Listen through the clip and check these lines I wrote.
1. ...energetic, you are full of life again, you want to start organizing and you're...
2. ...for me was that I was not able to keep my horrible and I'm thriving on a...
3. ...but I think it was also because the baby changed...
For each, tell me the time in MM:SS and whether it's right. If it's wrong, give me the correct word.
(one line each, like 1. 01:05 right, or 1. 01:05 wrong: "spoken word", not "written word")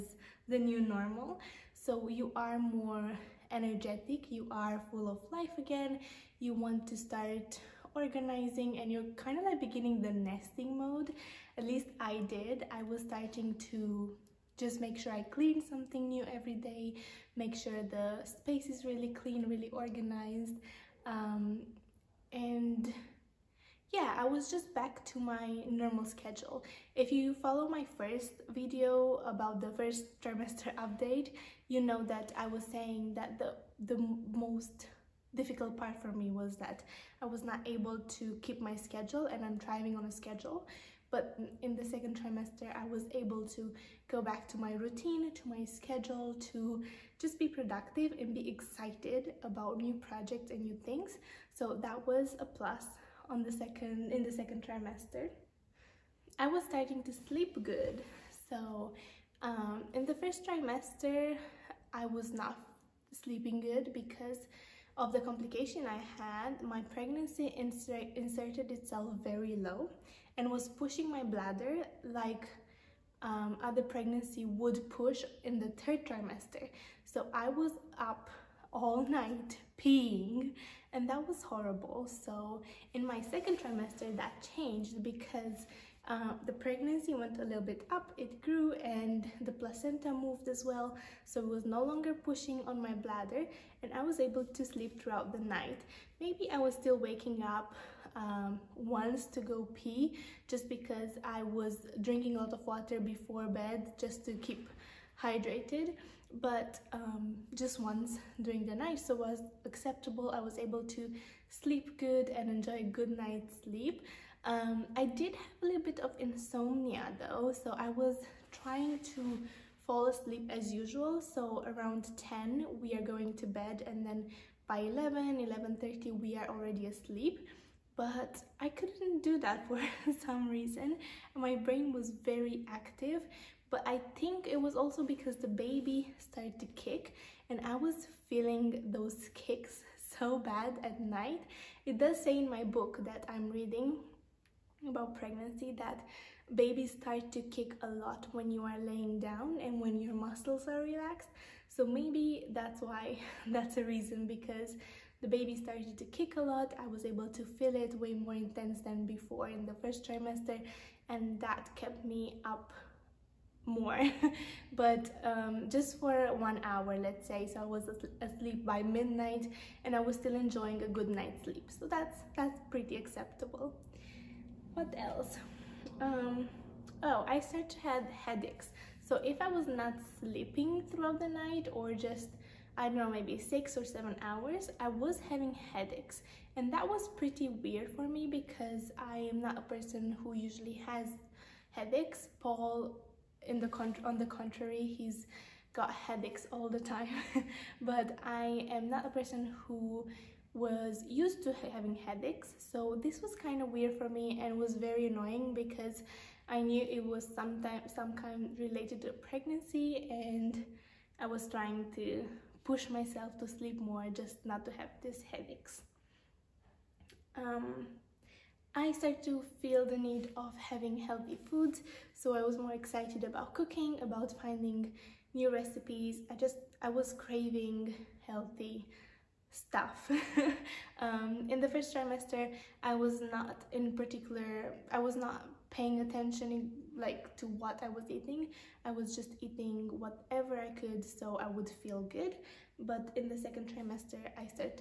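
1. 00:03 right
2. 00:36 wrong: "schedule", not "horrible"
3. 02:13 wrong: "started", not "changed".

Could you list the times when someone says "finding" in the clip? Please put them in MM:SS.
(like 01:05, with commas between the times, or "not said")
03:44.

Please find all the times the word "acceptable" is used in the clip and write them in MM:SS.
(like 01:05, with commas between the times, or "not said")
01:49, 02:52.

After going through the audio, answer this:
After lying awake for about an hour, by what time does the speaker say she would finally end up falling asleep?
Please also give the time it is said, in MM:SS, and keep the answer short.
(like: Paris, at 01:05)
midnight, at 02:48.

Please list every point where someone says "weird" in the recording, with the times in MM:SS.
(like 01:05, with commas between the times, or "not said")
03:07, 03:23.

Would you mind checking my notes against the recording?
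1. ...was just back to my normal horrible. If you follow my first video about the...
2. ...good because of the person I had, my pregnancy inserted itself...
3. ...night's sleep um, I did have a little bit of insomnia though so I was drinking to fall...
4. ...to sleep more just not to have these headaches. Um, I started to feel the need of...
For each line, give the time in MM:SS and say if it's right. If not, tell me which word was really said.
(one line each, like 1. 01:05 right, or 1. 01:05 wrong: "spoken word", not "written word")
1. 00:24 wrong: "schedule", not "horrible"
2. 01:03 wrong: "complication", not "person"
3. 01:53 wrong: "trying", not "drinking"
4. 03:33 right.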